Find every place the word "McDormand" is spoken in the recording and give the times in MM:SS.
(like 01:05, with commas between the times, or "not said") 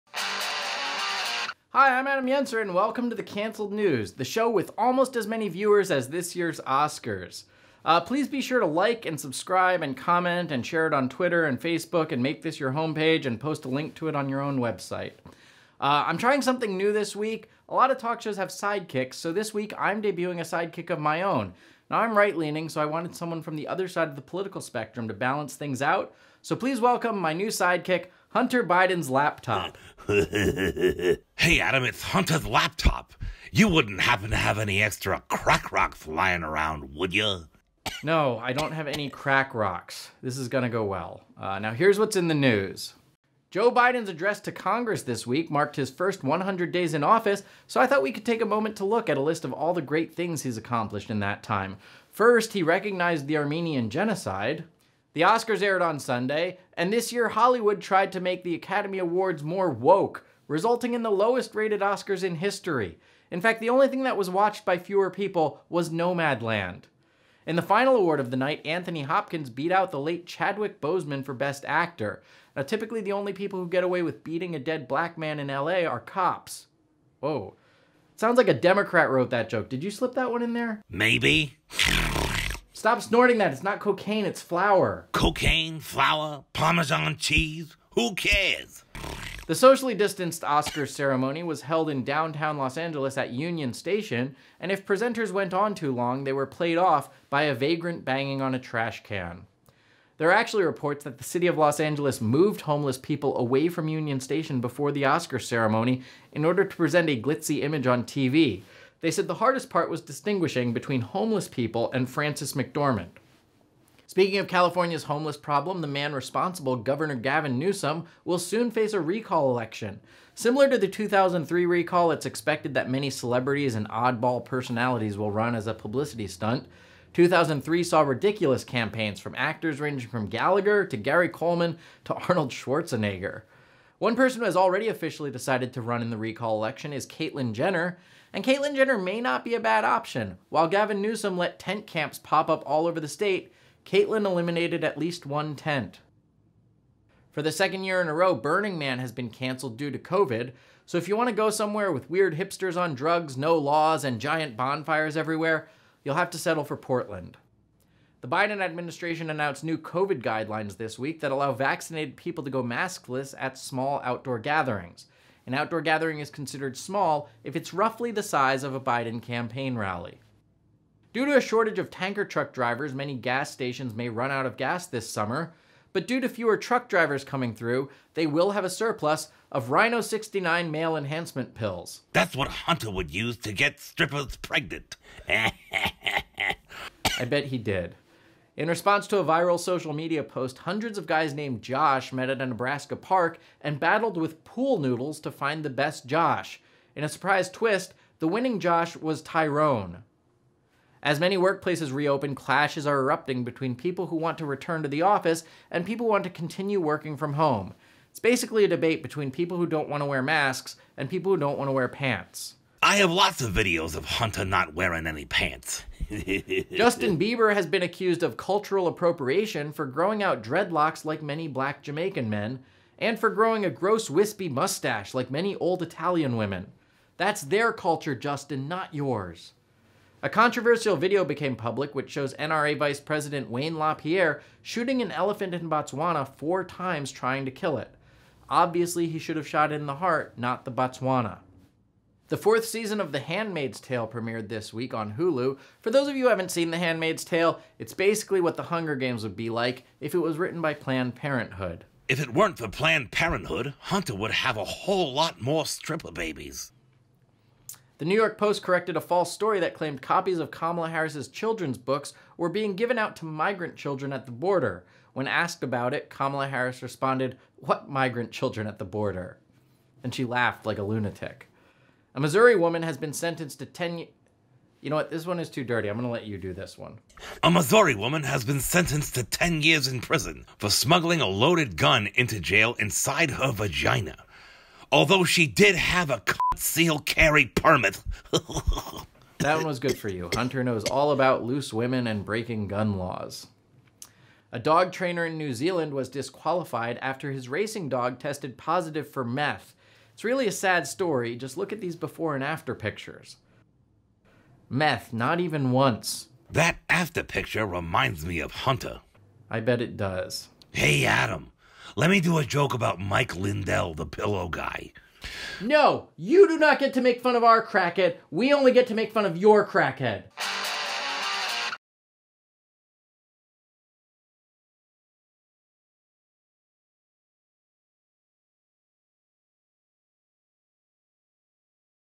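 01:52.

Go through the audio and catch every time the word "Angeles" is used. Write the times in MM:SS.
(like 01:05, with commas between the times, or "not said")
01:32, 01:41.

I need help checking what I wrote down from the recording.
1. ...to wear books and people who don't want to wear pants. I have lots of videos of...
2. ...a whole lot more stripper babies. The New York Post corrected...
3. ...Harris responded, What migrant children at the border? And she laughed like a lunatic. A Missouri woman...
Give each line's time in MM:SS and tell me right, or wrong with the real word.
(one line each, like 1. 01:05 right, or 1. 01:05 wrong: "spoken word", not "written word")
1. 03:30 wrong: "masks", not "books"
2. 04:14 right
3. 04:26 right.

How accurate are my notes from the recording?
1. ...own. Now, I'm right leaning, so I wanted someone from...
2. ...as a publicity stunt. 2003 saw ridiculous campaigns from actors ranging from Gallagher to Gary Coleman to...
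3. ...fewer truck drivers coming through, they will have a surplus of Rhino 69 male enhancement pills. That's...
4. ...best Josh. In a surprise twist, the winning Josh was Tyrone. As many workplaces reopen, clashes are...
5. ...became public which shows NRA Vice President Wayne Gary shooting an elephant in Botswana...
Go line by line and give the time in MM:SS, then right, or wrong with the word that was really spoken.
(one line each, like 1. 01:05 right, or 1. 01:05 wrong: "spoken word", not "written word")
1. 00:21 right
2. 02:05 right
3. 02:56 right
4. 03:15 right
5. 03:51 wrong: "LaPierre", not "Gary".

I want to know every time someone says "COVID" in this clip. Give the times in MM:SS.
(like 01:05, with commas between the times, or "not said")
02:29, 02:39.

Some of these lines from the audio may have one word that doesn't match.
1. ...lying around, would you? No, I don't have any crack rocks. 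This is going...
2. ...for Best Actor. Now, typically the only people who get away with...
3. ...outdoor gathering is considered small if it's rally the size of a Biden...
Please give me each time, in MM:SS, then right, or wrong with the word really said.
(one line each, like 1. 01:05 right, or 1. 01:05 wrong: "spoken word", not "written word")
1. 00:36 right
2. 01:11 right
3. 02:45 wrong: "roughly", not "rally".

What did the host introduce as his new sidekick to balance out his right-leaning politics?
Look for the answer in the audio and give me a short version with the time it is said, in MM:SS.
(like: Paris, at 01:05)
Hunter Biden's laptop, at 00:28.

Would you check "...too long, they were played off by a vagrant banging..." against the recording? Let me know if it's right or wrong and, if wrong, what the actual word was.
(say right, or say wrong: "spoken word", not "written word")
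right.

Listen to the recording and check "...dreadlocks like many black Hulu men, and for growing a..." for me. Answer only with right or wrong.
wrong.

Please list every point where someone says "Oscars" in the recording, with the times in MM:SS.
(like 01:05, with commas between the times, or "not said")
00:06, 00:55, 01:01, 01:30, 01:45.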